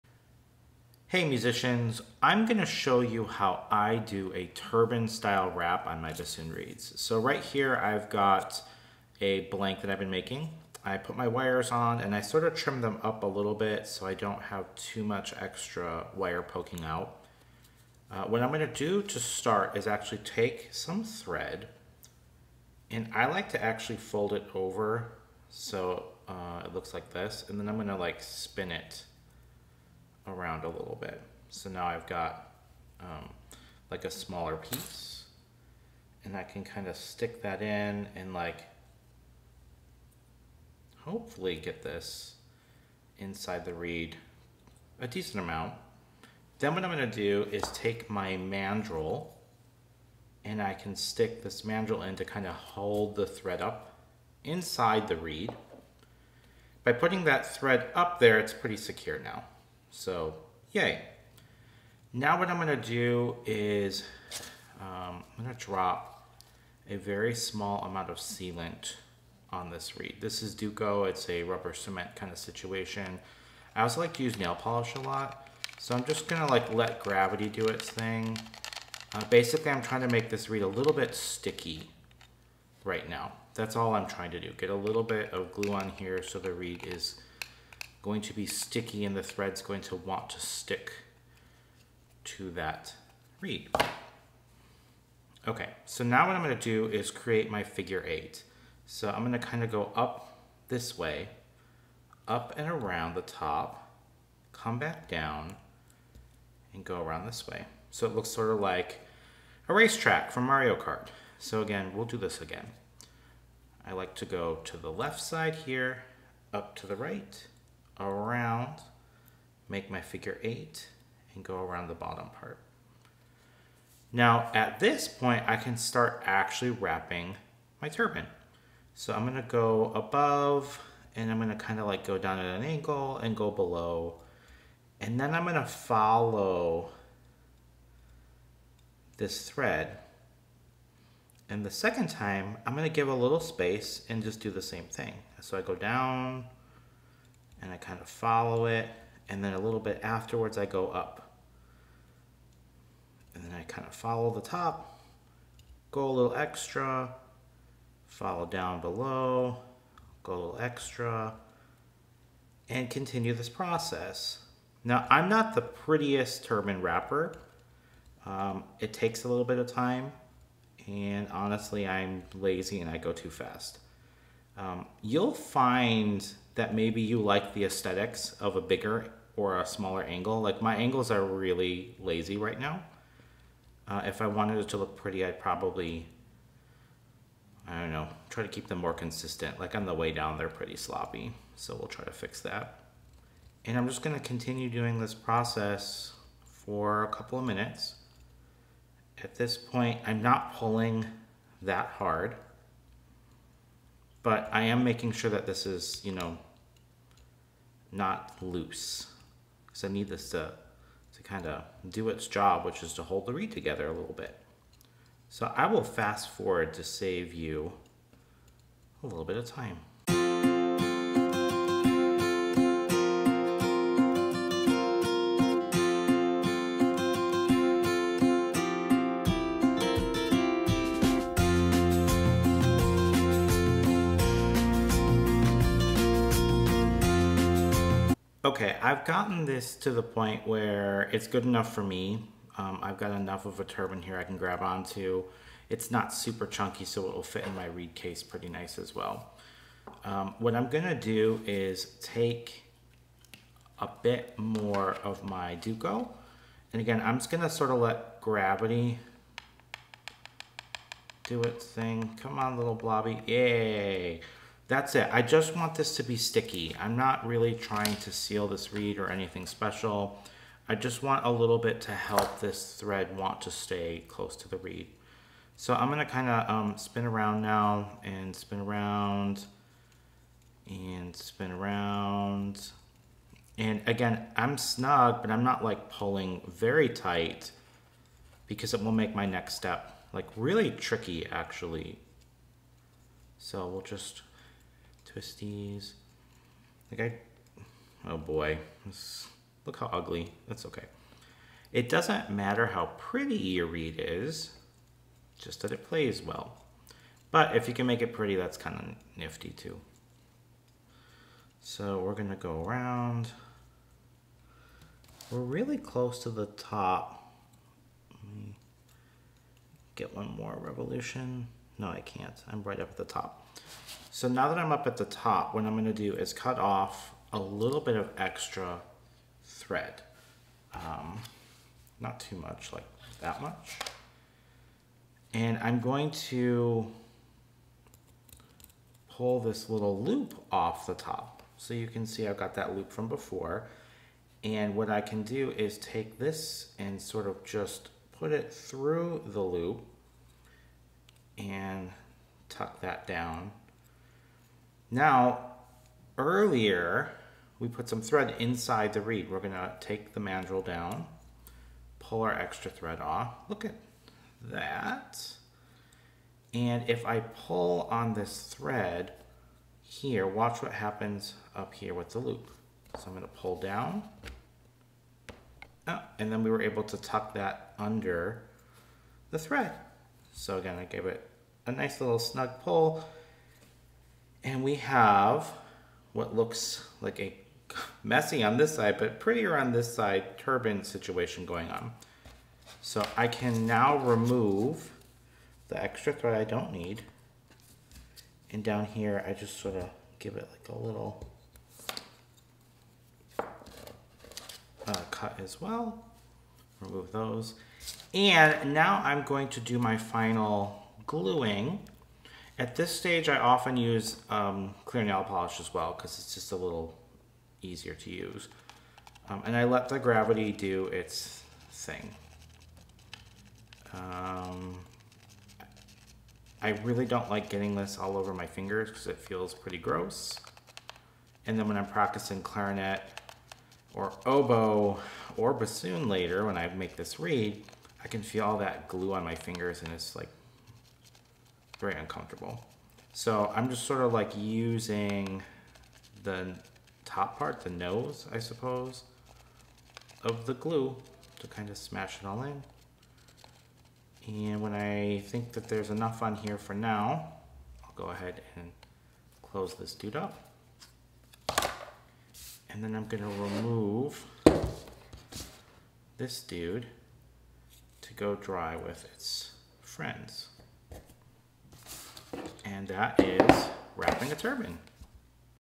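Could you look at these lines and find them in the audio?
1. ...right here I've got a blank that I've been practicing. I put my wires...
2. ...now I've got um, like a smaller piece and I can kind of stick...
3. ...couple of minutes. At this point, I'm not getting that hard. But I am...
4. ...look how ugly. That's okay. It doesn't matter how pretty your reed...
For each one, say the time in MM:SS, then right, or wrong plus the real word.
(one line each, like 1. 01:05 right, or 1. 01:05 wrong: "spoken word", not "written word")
1. 00:07 wrong: "making", not "practicing"
2. 00:31 right
3. 03:17 wrong: "pulling", not "getting"
4. 04:59 right.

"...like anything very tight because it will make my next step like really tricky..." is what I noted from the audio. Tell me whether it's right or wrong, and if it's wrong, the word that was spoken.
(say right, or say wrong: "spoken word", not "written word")
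wrong: "pulling", not "anything".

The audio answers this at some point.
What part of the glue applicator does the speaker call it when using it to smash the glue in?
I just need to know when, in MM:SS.
07:27.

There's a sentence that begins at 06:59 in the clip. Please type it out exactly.
Um, and I let the gravity do its thing.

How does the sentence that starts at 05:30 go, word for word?
Um, not too much, like that much.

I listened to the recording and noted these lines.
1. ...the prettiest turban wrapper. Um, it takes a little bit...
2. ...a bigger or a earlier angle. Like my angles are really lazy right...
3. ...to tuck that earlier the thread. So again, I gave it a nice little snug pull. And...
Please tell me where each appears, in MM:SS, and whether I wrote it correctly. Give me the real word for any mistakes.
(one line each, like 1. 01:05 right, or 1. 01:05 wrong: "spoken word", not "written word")
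1. 02:45 right
2. 02:58 wrong: "smaller", not "earlier"
3. 06:16 wrong: "under", not "earlier".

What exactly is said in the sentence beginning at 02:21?
And the second time, I'm gonna give a little space and just do the same thing.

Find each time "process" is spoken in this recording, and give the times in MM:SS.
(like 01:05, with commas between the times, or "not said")
02:43, 03:15.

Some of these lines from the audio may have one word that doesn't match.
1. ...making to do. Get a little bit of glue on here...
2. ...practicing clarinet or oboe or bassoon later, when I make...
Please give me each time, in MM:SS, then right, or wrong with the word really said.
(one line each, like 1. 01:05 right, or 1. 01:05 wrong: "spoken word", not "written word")
1. 01:24 wrong: "trying", not "making"
2. 07:11 right.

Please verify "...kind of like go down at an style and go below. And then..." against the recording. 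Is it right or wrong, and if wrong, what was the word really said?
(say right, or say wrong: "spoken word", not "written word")
wrong: "angle", not "style".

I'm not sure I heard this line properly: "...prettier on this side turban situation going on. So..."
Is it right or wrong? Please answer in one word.
right.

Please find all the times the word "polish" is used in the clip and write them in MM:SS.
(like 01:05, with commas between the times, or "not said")
01:14, 06:55.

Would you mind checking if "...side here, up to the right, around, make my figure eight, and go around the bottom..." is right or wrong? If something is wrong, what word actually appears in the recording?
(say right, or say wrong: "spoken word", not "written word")
right.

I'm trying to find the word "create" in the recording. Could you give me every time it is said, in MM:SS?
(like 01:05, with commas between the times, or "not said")
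01:37.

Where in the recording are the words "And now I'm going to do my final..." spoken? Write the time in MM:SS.
06:48.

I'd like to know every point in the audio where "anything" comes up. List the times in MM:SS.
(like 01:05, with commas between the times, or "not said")
04:29.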